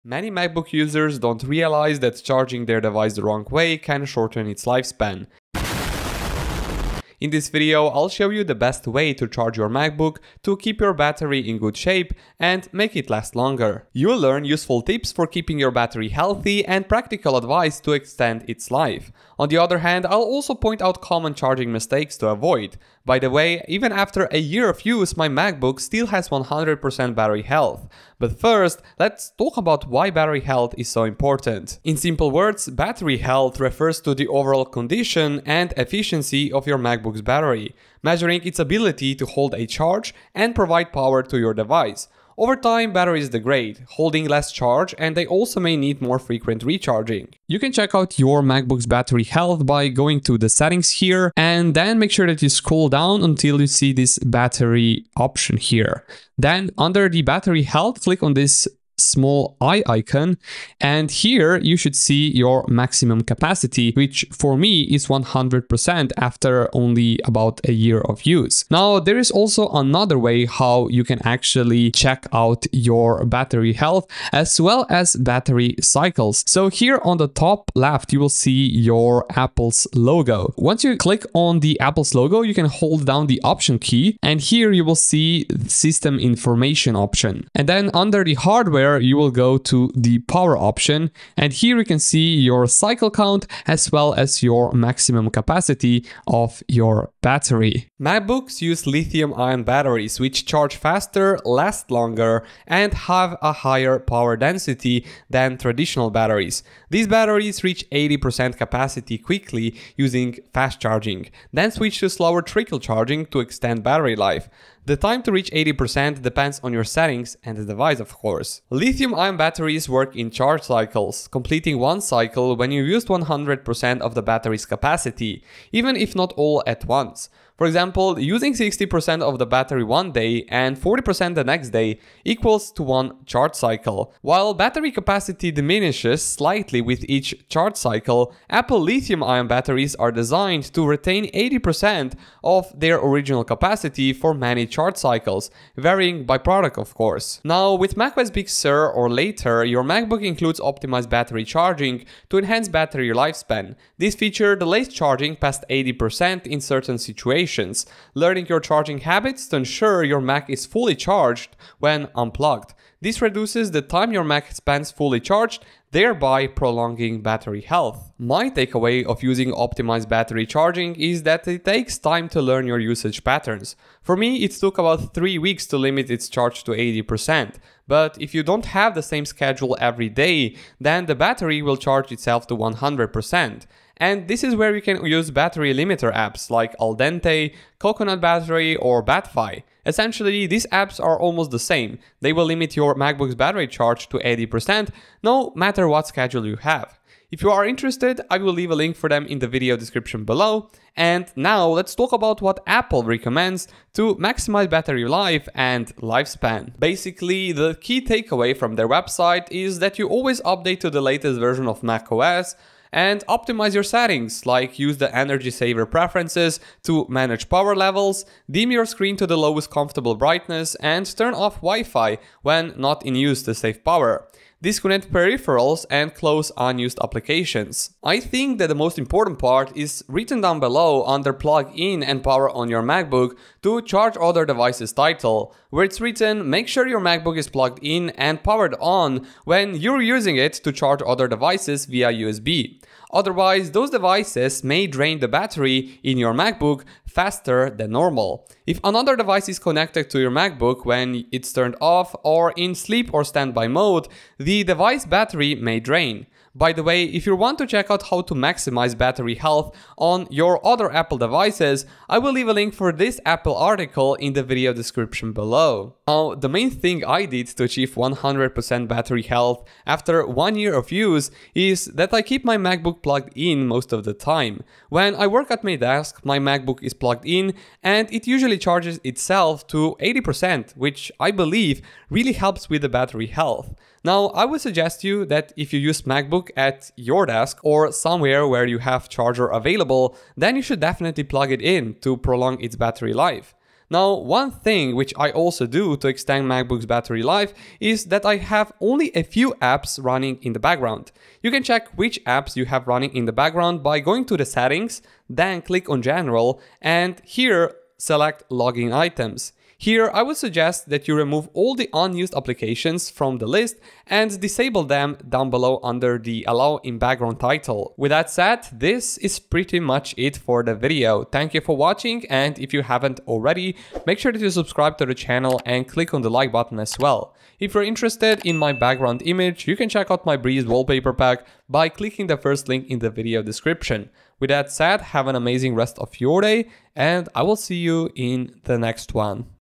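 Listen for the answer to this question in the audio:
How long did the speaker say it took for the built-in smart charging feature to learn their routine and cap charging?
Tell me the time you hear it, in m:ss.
2:54.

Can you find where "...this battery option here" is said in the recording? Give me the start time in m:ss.
0:53.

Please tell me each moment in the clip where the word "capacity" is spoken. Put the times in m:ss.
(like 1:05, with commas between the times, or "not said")
1:03, 1:35, 1:48, 2:04, 2:14, 2:23.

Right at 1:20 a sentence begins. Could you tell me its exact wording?
Once you click on the Apple's logo, you can hold down the option key and here you will see system information option.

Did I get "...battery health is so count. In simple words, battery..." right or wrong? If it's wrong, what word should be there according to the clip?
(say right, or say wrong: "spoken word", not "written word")
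wrong: "important", not "count".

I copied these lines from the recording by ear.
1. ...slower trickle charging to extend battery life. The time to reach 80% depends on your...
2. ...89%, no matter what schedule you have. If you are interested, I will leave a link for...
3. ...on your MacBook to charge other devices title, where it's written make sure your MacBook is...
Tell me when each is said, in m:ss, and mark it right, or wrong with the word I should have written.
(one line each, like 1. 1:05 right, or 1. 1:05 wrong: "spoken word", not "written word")
1. 1:52 right
2. 3:14 wrong: "80", not "89"
3. 3:52 right.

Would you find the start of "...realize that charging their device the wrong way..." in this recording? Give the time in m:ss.
0:01.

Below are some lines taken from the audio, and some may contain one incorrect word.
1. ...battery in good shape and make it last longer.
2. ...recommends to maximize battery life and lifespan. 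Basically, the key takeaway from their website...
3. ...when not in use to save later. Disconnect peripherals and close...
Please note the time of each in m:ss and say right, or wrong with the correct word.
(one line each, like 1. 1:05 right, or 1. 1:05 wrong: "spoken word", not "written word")
1. 0:10 right
2. 3:23 right
3. 3:42 wrong: "power", not "later".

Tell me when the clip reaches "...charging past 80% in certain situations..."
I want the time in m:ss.
2:34.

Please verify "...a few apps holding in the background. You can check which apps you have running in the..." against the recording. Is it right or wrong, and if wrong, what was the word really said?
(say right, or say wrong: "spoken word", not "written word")
wrong: "running", not "holding".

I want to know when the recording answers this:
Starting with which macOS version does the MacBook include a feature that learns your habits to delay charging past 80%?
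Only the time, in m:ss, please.
2:27.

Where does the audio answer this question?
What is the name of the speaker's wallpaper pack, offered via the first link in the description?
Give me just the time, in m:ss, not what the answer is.
5:30.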